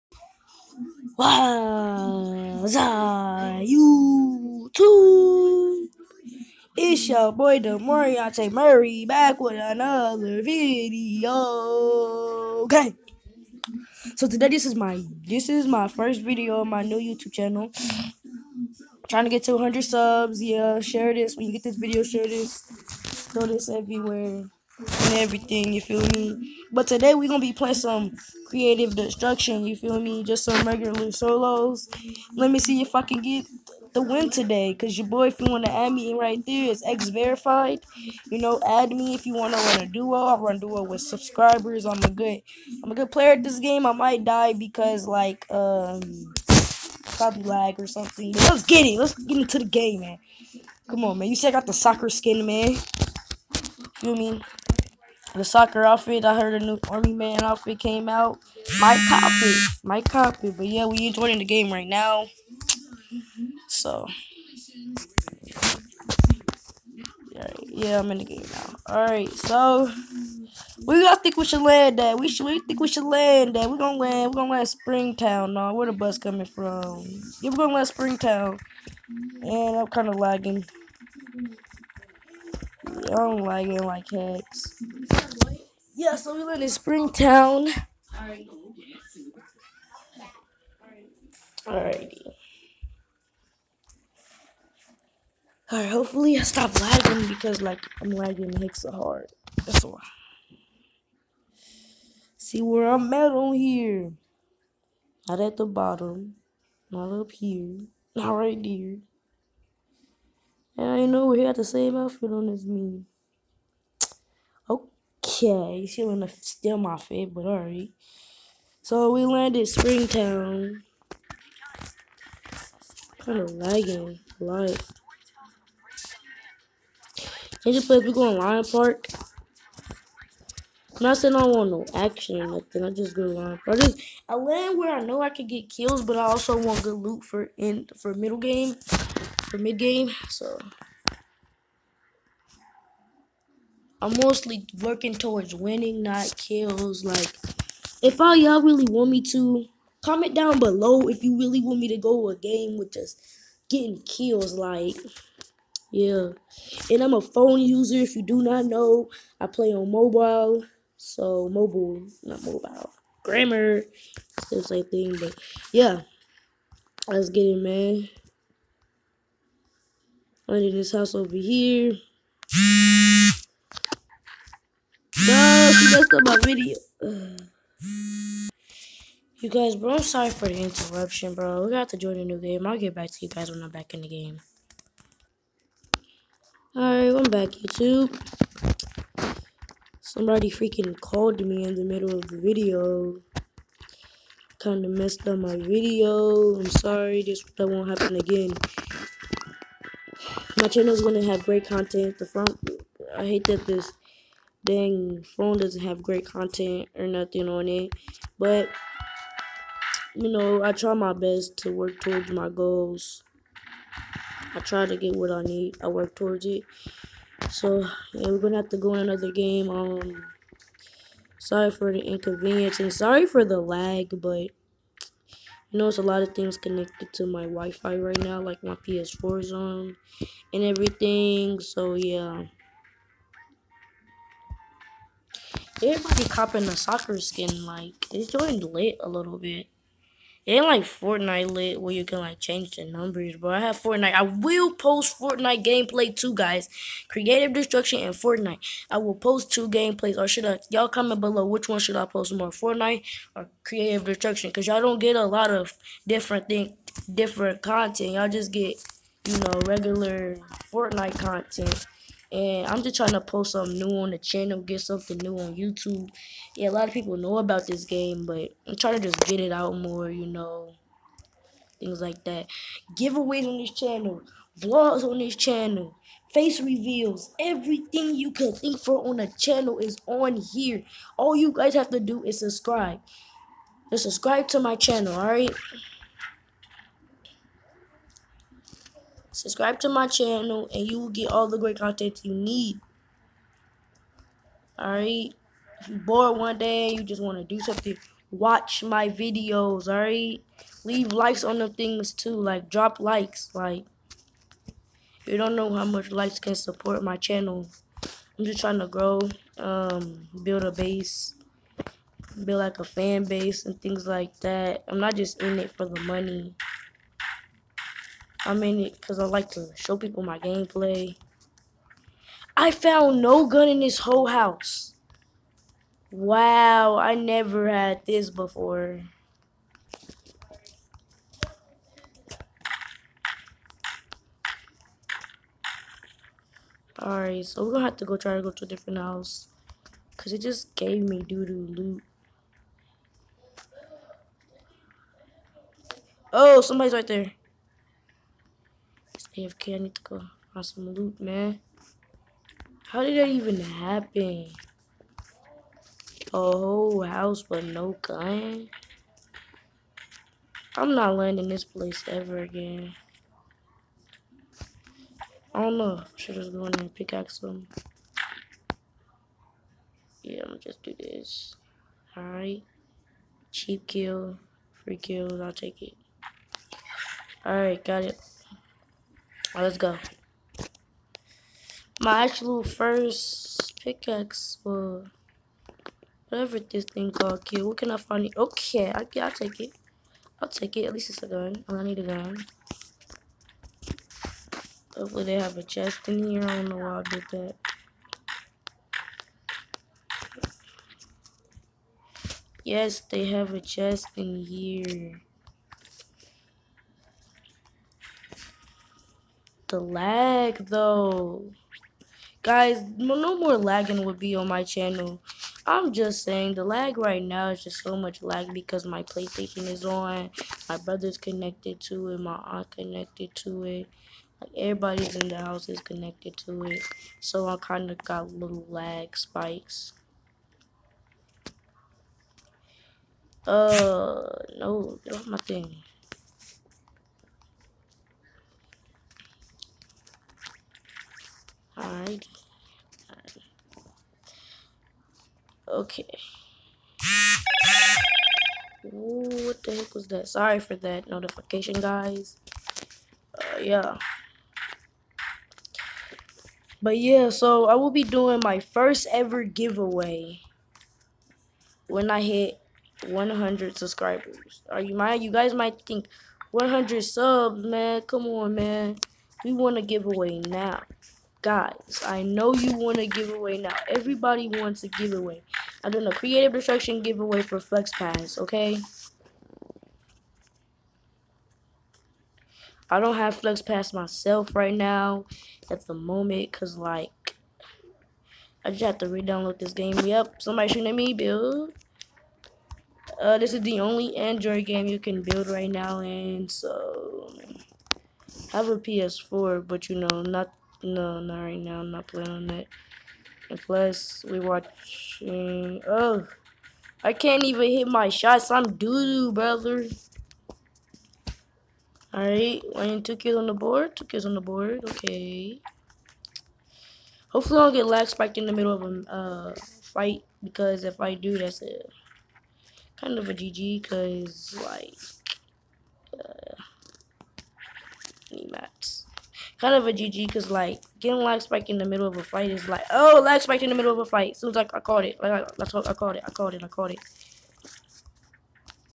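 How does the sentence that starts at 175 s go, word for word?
No, she messed up my video.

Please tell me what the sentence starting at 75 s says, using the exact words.
No, where the bus coming from?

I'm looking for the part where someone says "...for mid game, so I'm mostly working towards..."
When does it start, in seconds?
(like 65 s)
139 s.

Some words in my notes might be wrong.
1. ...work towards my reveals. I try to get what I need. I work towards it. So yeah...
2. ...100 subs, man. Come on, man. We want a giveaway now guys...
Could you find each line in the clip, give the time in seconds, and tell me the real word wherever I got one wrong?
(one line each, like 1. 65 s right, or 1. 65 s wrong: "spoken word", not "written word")
1. 211 s wrong: "goals", not "reveals"
2. 466 s right.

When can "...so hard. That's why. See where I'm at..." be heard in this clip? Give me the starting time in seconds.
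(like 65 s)
98 s.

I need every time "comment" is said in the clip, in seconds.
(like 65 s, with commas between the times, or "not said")
150 s, 250 s.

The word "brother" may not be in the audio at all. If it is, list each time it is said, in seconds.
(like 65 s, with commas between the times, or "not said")
420 s, 509 s.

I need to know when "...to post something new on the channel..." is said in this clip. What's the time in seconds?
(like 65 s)
263 s.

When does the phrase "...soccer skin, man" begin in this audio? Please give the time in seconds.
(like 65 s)
51 s.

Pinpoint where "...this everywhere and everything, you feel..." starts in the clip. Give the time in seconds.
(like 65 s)
23 s.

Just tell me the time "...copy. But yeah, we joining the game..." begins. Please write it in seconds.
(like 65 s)
60 s.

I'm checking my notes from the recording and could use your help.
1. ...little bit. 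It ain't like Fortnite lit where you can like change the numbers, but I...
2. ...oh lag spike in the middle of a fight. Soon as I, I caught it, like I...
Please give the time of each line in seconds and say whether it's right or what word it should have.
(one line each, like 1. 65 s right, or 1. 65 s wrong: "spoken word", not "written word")
1. 239 s right
2. 532 s right.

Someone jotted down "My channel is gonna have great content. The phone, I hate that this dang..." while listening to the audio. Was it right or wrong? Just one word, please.
right.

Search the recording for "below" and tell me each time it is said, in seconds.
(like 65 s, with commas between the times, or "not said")
150 s, 251 s.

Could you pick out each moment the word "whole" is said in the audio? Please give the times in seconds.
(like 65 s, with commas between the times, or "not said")
323 s, 356 s.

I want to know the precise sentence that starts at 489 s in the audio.
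Yep, somebody shooting at me, build.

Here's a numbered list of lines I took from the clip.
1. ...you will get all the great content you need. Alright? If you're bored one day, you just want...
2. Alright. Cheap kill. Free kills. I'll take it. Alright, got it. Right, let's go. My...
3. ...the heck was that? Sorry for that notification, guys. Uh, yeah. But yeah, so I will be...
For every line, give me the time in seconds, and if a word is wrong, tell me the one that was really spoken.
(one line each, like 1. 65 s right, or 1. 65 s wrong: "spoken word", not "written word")
1. 290 s right
2. 372 s right
3. 449 s right.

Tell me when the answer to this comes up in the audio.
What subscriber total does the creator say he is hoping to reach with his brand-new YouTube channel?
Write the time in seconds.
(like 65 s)
19 s.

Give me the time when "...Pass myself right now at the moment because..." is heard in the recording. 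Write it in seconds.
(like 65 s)
483 s.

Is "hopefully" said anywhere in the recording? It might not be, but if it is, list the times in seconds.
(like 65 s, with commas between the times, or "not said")
95 s, 394 s, 517 s.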